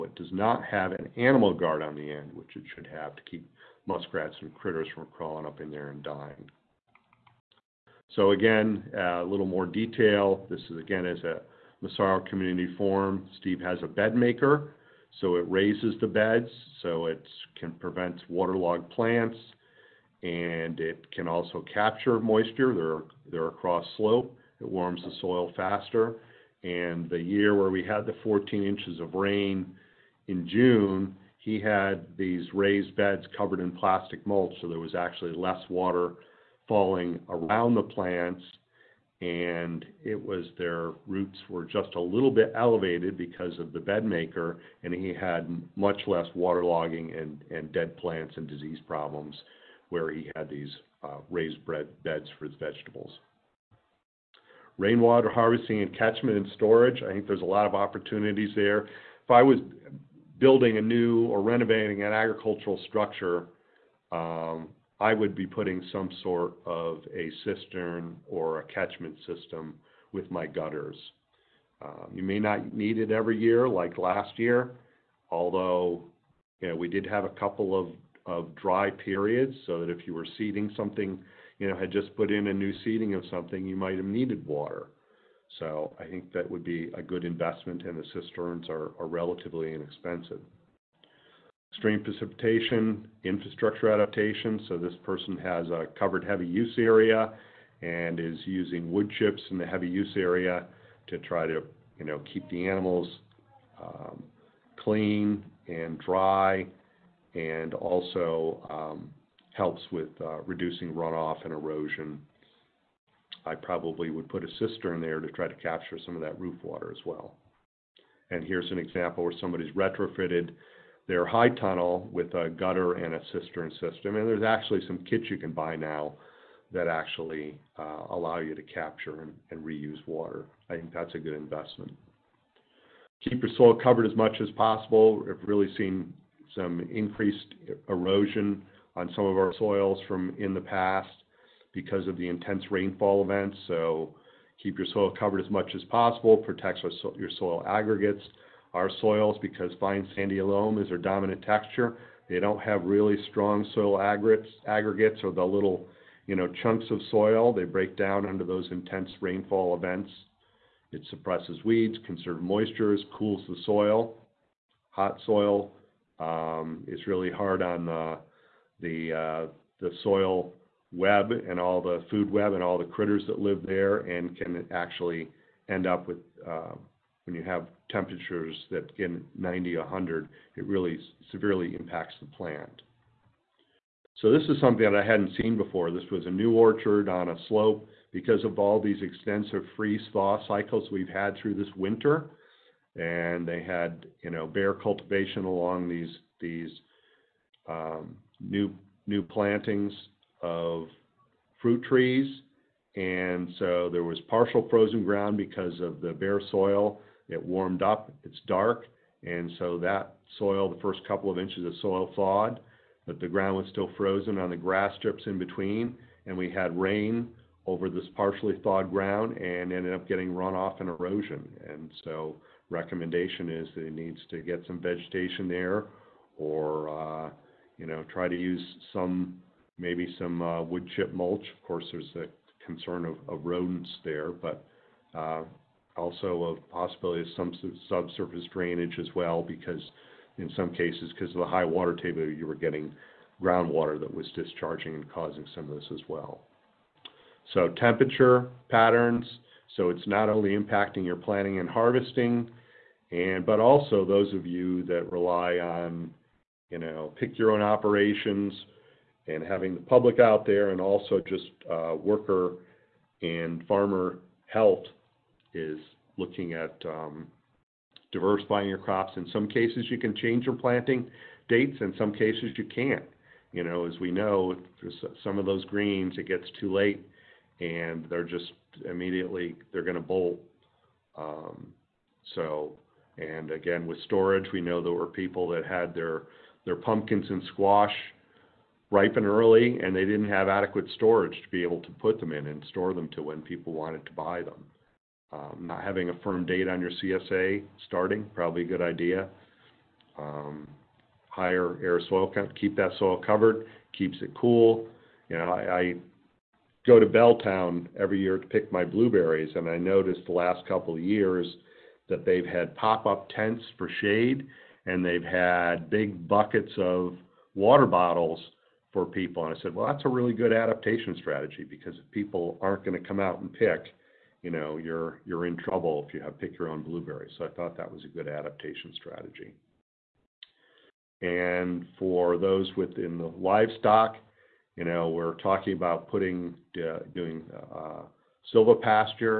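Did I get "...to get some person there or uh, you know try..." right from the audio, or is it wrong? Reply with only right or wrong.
wrong.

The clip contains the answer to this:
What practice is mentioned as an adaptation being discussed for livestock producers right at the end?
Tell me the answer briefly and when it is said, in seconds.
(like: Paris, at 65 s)
silvopasture, at 338 s.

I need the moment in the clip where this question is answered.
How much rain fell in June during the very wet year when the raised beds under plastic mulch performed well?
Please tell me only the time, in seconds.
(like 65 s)
28 s.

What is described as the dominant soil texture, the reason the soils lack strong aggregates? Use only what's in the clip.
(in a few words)
fine sandy loam.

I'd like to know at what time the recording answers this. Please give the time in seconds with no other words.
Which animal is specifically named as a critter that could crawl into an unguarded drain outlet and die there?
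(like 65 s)
3 s.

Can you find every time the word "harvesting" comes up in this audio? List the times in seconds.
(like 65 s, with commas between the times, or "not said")
55 s, 251 s.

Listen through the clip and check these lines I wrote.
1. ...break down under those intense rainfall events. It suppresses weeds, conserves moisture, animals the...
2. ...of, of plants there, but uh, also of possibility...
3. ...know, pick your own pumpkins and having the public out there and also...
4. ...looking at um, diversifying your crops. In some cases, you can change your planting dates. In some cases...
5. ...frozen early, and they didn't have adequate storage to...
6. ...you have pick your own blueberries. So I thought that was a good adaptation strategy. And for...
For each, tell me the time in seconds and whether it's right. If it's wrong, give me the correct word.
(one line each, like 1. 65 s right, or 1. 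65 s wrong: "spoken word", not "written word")
1. 157 s wrong: "cools", not "animals"
2. 233 s wrong: "rodents", not "plants"
3. 256 s wrong: "operations", not "pumpkins"
4. 266 s right
5. 288 s wrong: "ripen", not "frozen"
6. 326 s right.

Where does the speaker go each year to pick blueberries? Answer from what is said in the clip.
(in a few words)
Belltown.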